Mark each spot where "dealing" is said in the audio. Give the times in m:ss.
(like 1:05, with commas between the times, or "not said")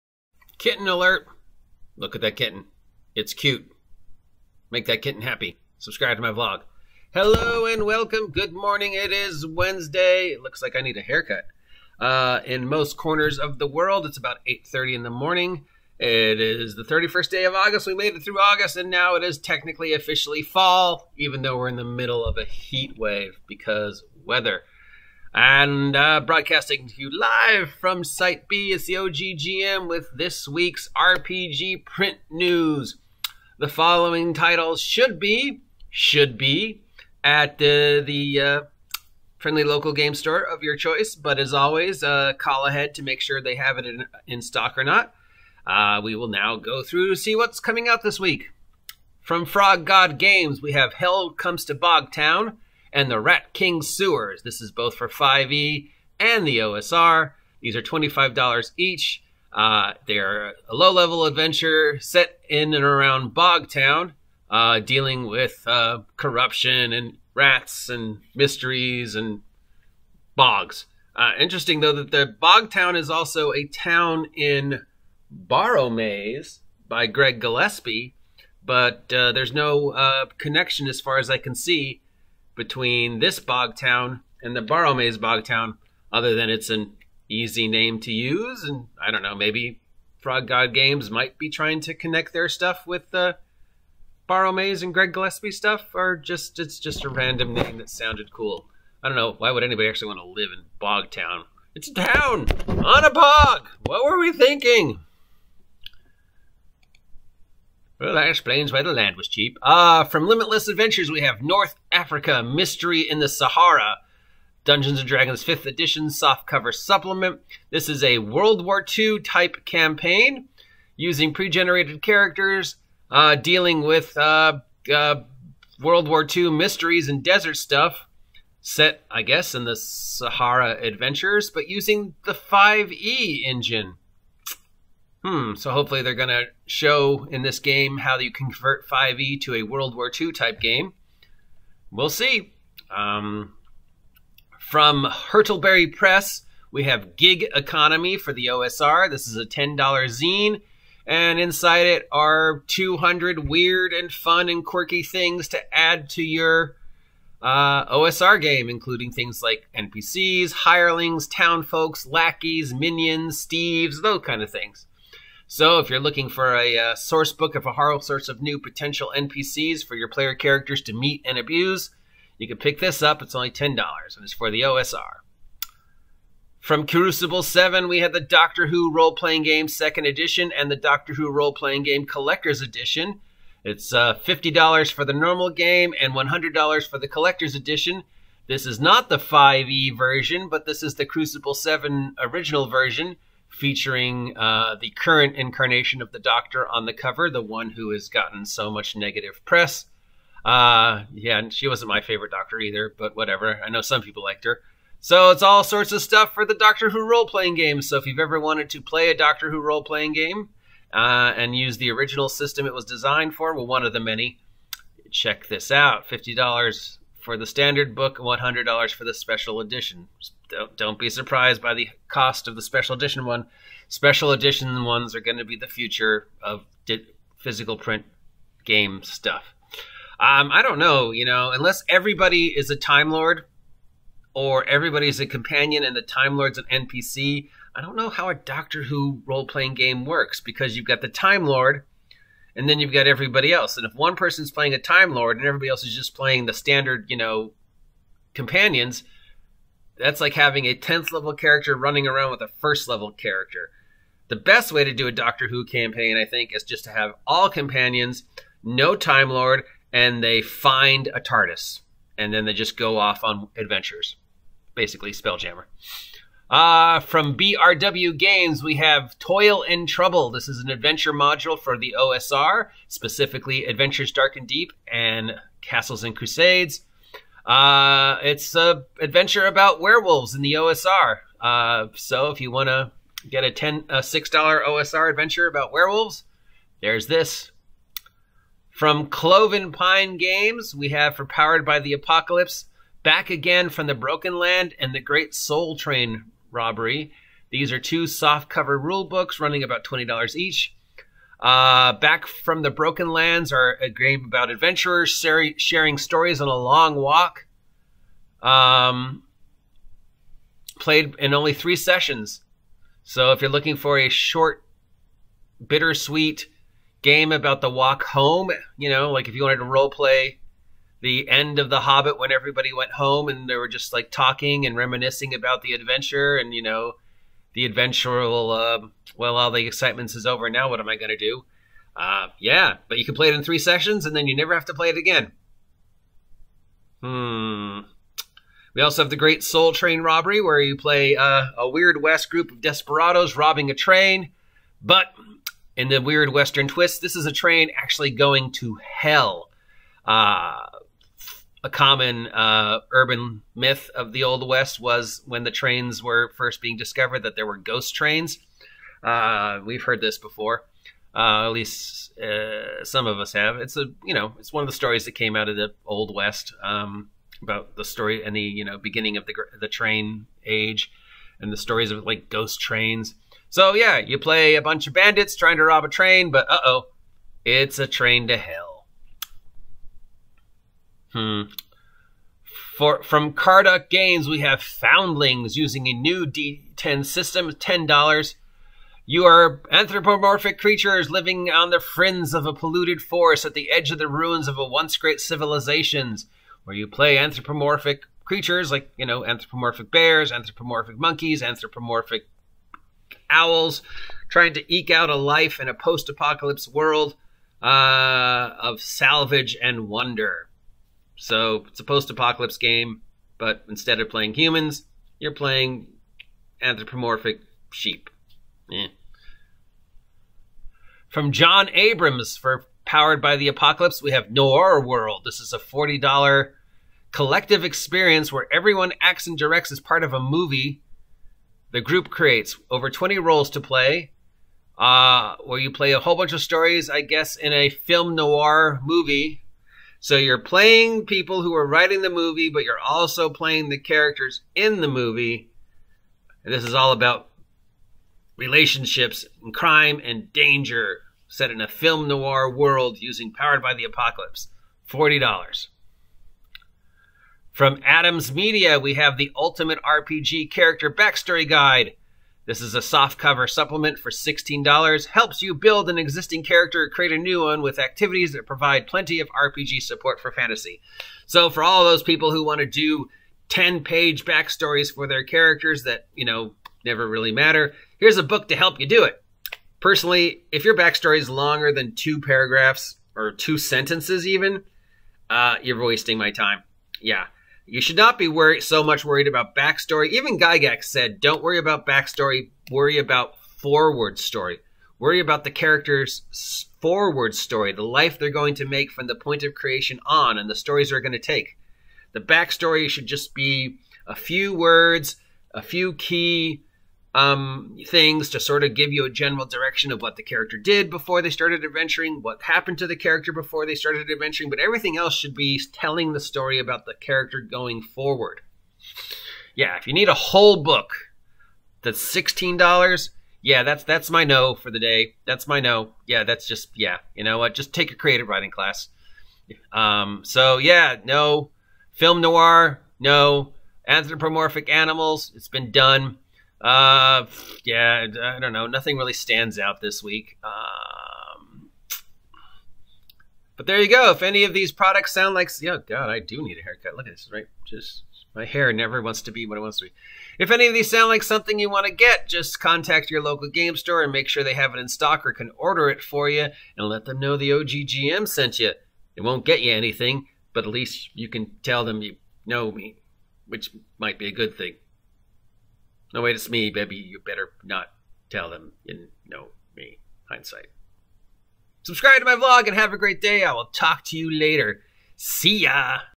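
1:04, 2:03.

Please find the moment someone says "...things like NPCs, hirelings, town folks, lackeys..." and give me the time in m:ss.
2:39.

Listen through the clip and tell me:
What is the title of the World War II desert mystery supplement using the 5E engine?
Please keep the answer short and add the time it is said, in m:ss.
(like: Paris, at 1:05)
North Africa Mystery in the Sahara, at 1:51.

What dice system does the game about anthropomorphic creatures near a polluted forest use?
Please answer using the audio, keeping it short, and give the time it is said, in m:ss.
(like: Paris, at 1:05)
D10, at 6:26.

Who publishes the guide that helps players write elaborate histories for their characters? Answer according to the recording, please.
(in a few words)
Adams Media.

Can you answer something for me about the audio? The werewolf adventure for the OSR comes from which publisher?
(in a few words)
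BRW Games.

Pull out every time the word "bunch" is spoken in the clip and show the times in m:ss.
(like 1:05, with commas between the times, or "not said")
6:14, 7:16.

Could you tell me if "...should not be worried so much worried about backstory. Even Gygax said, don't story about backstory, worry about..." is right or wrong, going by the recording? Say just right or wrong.
wrong.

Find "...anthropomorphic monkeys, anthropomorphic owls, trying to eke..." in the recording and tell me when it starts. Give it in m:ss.
6:40.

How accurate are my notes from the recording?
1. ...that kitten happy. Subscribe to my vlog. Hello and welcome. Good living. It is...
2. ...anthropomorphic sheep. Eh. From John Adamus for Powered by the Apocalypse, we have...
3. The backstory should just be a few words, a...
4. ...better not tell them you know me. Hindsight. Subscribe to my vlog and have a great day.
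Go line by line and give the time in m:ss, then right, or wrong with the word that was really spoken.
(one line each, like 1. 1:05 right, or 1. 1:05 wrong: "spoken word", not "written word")
1. 0:04 wrong: "morning", not "living"
2. 6:56 right
3. 8:22 right
4. 9:27 right.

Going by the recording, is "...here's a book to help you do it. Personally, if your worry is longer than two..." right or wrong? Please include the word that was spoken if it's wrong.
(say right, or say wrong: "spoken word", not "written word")
wrong: "backstory", not "worry".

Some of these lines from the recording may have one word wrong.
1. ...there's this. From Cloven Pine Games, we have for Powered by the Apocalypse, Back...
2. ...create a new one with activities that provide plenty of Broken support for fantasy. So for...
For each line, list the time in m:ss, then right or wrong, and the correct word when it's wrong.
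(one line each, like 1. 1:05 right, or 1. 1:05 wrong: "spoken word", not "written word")
1. 4:46 right
2. 7:46 wrong: "RPG", not "Broken".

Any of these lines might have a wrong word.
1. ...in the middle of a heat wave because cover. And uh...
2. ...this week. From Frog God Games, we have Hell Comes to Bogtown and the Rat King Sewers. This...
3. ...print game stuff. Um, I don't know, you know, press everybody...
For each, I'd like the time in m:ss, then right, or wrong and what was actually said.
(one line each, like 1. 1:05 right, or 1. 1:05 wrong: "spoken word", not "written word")
1. 0:21 wrong: "weather", not "cover"
2. 0:48 right
3. 3:47 wrong: "unless", not "press".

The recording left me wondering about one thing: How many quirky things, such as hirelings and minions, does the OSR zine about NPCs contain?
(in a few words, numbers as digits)
200.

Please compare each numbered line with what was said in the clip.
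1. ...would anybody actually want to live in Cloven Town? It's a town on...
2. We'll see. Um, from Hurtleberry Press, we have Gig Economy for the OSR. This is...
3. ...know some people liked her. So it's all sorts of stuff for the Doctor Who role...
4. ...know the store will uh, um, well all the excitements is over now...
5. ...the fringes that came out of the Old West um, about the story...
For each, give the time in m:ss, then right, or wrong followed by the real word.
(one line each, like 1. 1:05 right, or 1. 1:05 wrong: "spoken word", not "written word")
1. 1:39 wrong: "Bog", not "Cloven"
2. 2:21 right
3. 3:23 right
4. 5:26 wrong: "adventure", not "store"
5. 6:04 wrong: "stories", not "fringes".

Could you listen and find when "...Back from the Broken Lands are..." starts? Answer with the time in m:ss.
5:01.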